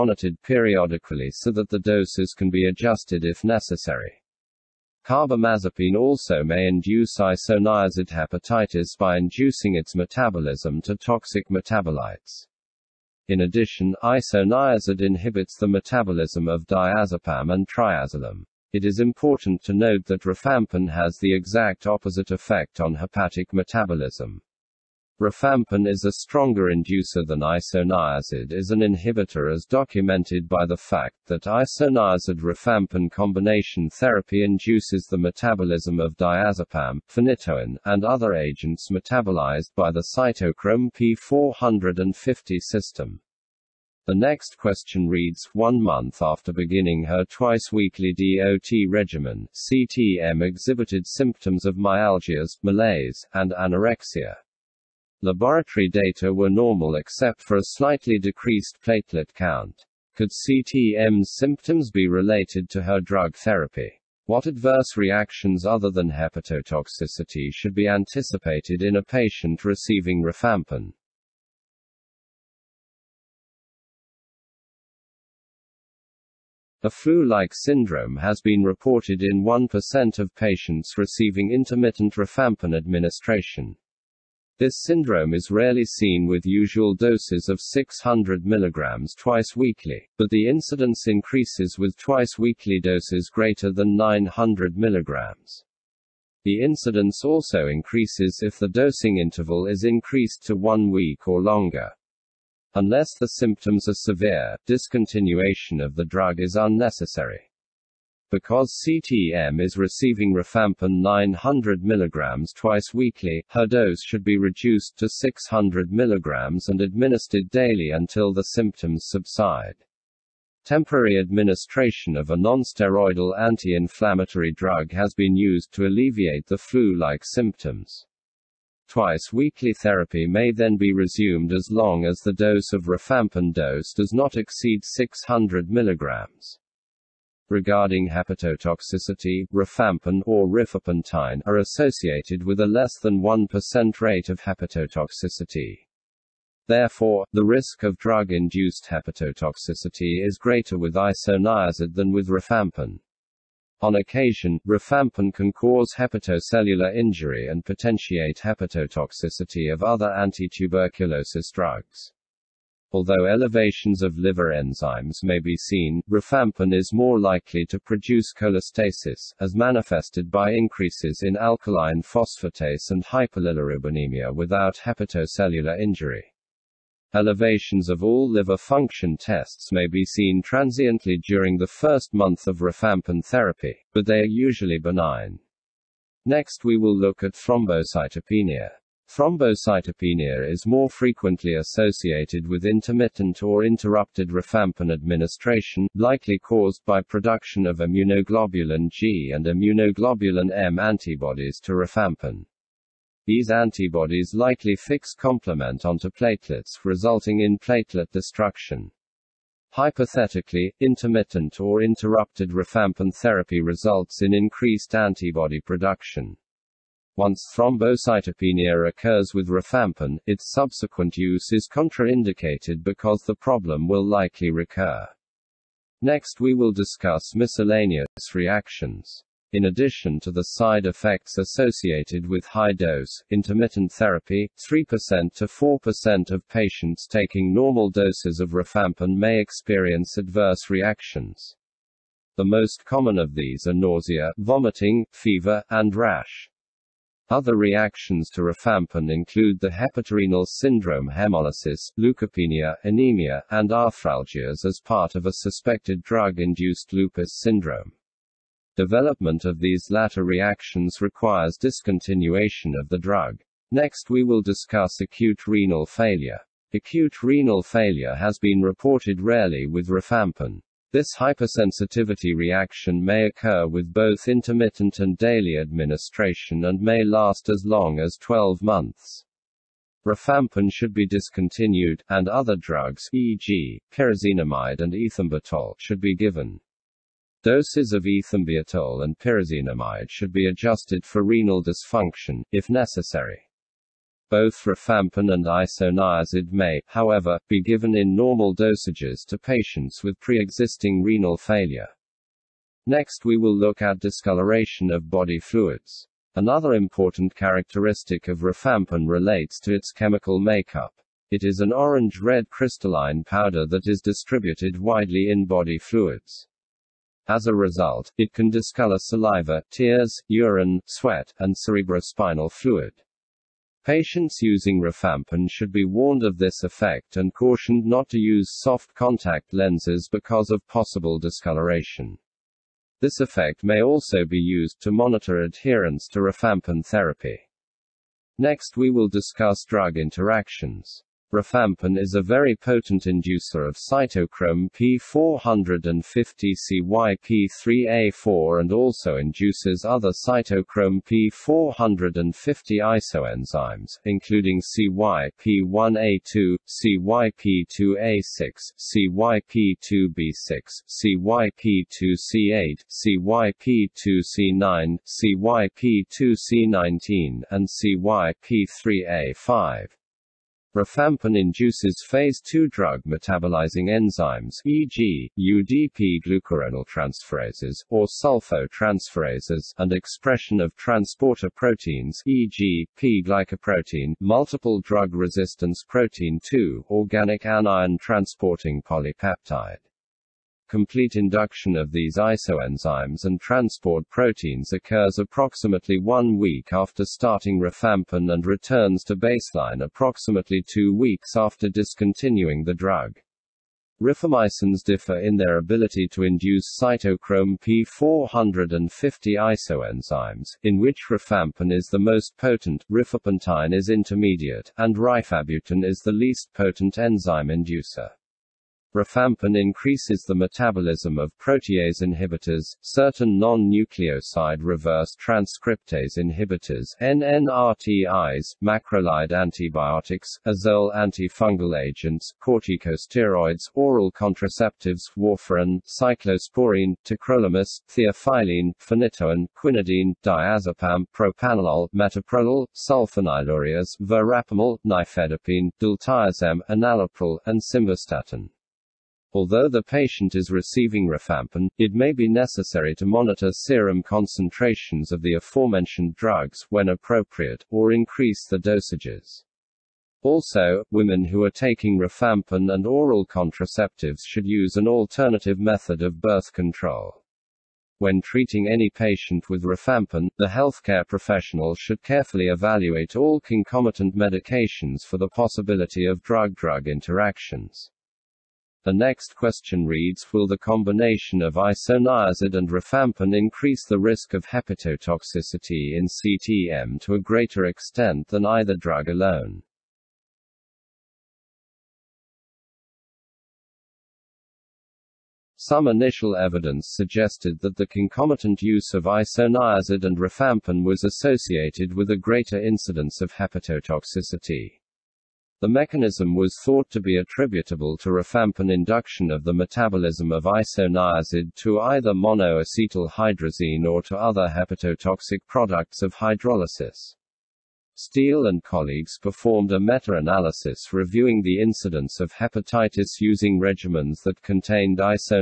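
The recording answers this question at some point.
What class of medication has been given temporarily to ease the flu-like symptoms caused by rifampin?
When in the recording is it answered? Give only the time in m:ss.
2:02.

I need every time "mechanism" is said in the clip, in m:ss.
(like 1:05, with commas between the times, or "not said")
8:25.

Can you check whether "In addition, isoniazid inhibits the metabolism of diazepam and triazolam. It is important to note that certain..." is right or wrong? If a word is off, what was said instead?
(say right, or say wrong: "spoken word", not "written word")
wrong: "rifampin", not "certain".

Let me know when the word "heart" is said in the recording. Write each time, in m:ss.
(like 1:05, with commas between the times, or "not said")
not said.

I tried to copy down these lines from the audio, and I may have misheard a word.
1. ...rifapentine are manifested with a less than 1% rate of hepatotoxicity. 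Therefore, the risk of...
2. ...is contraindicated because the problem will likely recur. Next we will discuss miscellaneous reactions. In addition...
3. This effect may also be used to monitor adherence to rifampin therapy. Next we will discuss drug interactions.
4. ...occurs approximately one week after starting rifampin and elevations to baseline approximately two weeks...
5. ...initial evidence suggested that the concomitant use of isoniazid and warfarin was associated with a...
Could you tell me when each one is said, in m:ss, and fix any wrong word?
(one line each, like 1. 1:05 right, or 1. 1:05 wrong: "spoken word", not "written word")
1. 2:20 wrong: "associated", not "manifested"
2. 3:41 right
3. 5:32 right
4. 6:34 wrong: "returns", not "elevations"
5. 8:15 wrong: "rifampin", not "warfarin".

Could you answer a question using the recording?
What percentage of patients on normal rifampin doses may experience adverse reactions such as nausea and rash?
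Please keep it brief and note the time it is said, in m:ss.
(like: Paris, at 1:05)
3% to 4%, at 3:54.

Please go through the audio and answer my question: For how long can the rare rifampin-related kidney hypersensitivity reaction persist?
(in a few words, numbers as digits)
12 months.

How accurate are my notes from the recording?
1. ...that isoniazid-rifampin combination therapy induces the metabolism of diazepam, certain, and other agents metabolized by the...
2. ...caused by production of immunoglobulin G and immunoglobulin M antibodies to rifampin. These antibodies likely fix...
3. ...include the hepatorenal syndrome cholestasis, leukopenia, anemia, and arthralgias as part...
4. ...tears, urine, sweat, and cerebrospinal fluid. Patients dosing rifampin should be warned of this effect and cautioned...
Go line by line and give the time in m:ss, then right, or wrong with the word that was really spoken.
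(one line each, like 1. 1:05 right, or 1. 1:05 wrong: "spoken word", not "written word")
1. 0:31 wrong: "phenytoin", not "certain"
2. 3:16 right
3. 4:09 wrong: "hemolysis", not "cholestasis"
4. 5:19 wrong: "using", not "dosing".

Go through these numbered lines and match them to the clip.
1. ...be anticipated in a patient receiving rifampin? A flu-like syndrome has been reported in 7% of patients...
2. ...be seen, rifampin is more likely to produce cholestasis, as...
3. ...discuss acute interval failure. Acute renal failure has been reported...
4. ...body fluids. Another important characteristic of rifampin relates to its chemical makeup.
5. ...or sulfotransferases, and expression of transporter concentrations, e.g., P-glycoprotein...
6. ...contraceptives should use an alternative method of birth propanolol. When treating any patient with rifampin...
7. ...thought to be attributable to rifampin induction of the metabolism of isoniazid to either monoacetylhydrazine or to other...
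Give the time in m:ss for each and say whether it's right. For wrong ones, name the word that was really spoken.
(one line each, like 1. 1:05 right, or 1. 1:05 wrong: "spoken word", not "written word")
1. 1:07 wrong: "1", not "7"
2. 2:45 right
3. 4:24 wrong: "renal", not "interval"
4. 5:05 right
5. 6:17 wrong: "proteins", not "concentrations"
6. 7:43 wrong: "control", not "propanolol"
7. 8:26 right.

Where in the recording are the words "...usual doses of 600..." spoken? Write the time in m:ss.
1:26.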